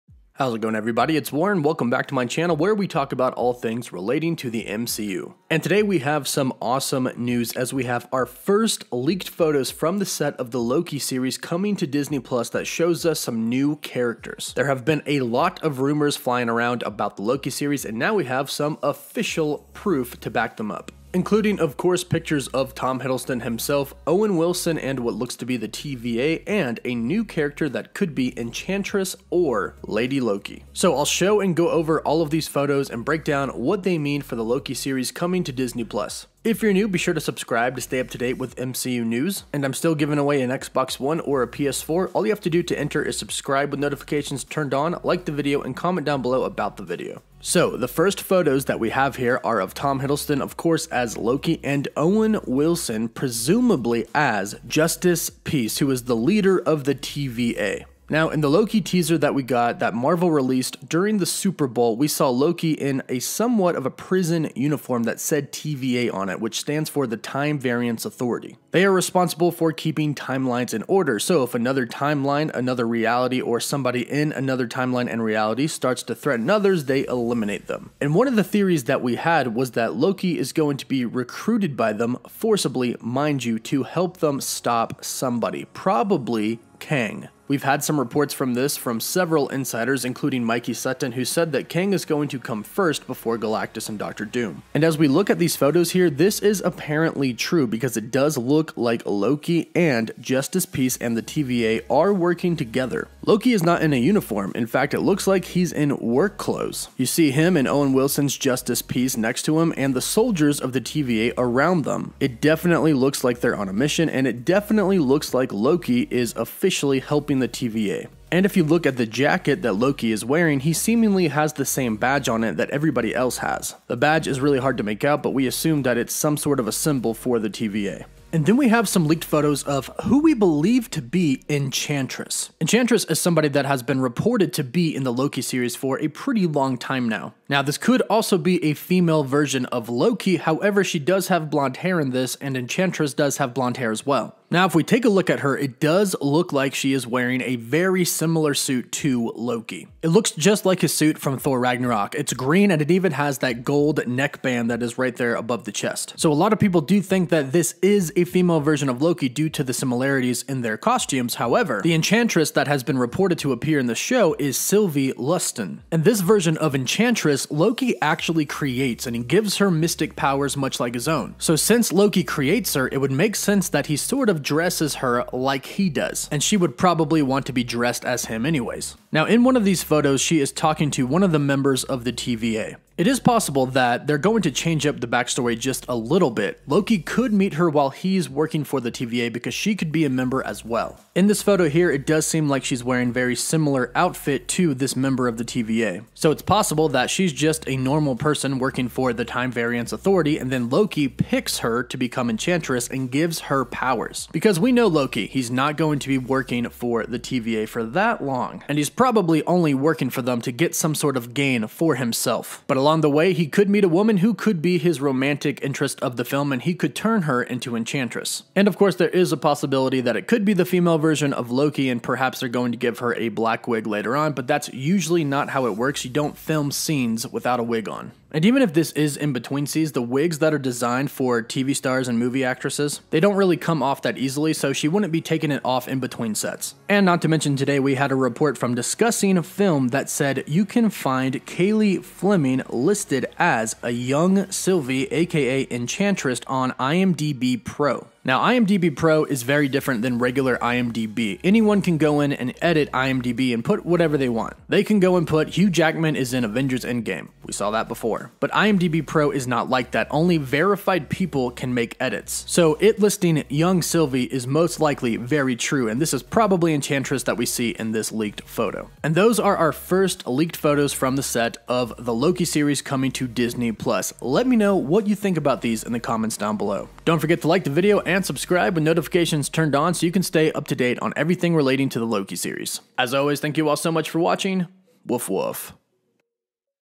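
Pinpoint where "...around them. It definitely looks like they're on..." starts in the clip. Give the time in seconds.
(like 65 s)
111 s.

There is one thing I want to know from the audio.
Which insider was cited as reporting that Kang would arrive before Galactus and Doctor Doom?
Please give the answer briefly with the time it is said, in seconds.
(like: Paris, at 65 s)
Mikey Sutton, at 90 s.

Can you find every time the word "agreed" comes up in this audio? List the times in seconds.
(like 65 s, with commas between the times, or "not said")
not said.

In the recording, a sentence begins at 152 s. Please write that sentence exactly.
It's green and it even has that gold neckband that is right there above the chest.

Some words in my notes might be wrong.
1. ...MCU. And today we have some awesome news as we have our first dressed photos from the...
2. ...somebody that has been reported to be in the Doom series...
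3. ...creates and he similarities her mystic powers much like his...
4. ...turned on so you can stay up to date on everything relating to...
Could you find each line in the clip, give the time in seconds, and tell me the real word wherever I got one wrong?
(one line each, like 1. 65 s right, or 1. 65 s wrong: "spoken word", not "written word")
1. 4 s wrong: "leaked", not "dressed"
2. 133 s wrong: "Loki", not "Doom"
3. 168 s wrong: "gives", not "similarities"
4. 279 s right.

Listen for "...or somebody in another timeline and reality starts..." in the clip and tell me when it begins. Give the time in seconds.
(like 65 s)
73 s.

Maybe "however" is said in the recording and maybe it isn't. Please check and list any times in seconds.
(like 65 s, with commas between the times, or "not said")
140 s, 161 s.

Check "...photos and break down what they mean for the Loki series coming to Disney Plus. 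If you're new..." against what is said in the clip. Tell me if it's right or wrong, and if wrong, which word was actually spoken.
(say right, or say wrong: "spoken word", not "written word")
right.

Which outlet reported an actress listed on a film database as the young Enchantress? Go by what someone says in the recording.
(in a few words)
Discussing a Film.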